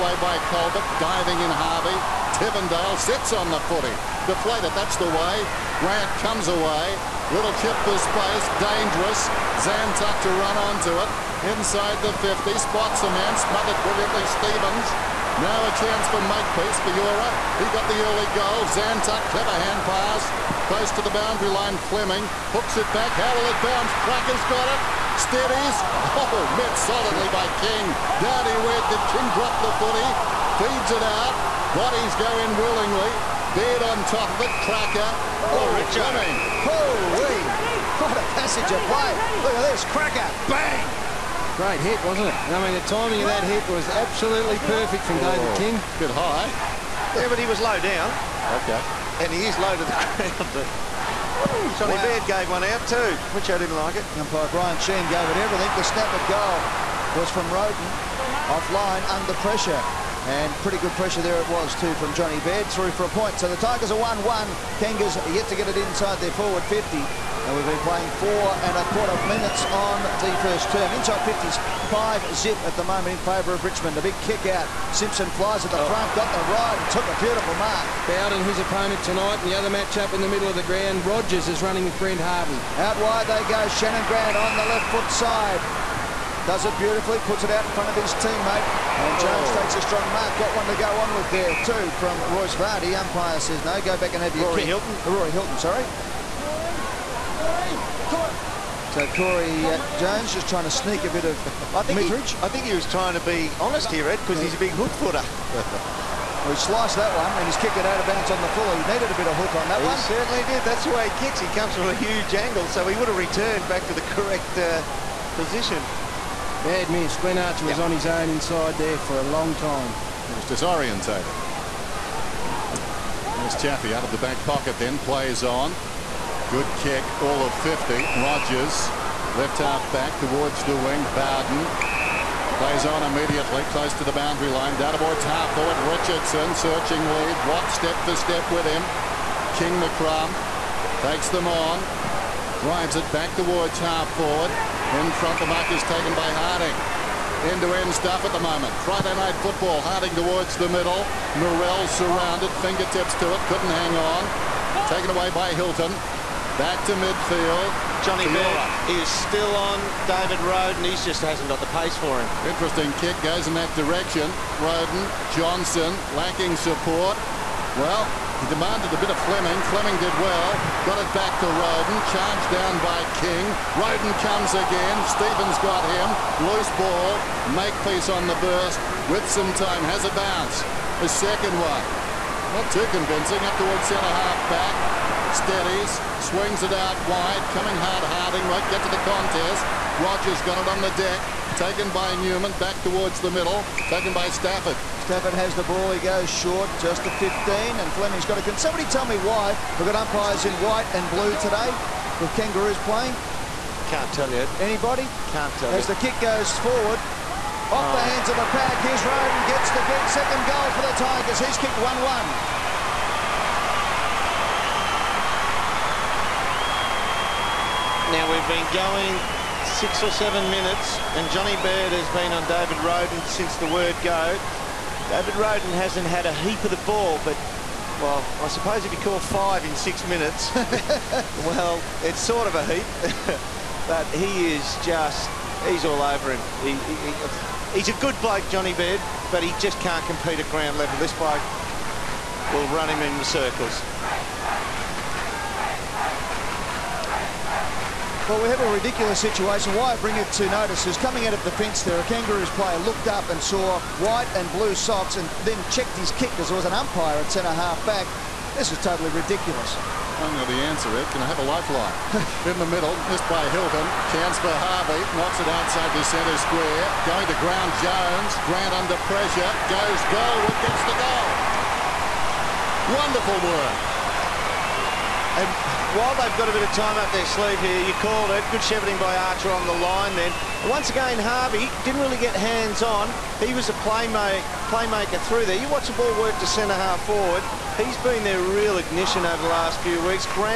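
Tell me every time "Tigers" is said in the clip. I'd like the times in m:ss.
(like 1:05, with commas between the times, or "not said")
1:03, 3:30.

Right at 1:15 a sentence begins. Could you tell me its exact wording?
front, got the ride and took a beautiful mark.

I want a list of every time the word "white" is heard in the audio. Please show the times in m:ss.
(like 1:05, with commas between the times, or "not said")
3:20, 4:14.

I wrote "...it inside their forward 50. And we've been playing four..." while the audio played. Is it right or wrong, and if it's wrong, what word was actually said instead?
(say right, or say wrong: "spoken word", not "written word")
right.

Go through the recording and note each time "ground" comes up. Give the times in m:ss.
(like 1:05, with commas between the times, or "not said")
0:49, 1:20, 4:00, 4:27.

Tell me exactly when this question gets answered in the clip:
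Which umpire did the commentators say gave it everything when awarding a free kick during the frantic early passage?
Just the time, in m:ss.
0:54.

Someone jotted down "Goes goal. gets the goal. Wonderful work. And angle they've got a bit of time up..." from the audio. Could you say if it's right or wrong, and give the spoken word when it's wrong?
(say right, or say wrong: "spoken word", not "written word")
wrong: "while", not "angle".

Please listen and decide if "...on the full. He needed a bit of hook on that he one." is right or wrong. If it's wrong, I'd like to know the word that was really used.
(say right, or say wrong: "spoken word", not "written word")
right.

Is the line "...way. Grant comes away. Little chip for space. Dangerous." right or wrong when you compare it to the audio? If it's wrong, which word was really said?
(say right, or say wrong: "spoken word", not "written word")
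right.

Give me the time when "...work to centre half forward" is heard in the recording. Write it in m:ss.
4:46.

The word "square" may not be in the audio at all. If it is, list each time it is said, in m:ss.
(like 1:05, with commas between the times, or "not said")
4:26.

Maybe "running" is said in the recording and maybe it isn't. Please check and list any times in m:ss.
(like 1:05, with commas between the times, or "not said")
1:21.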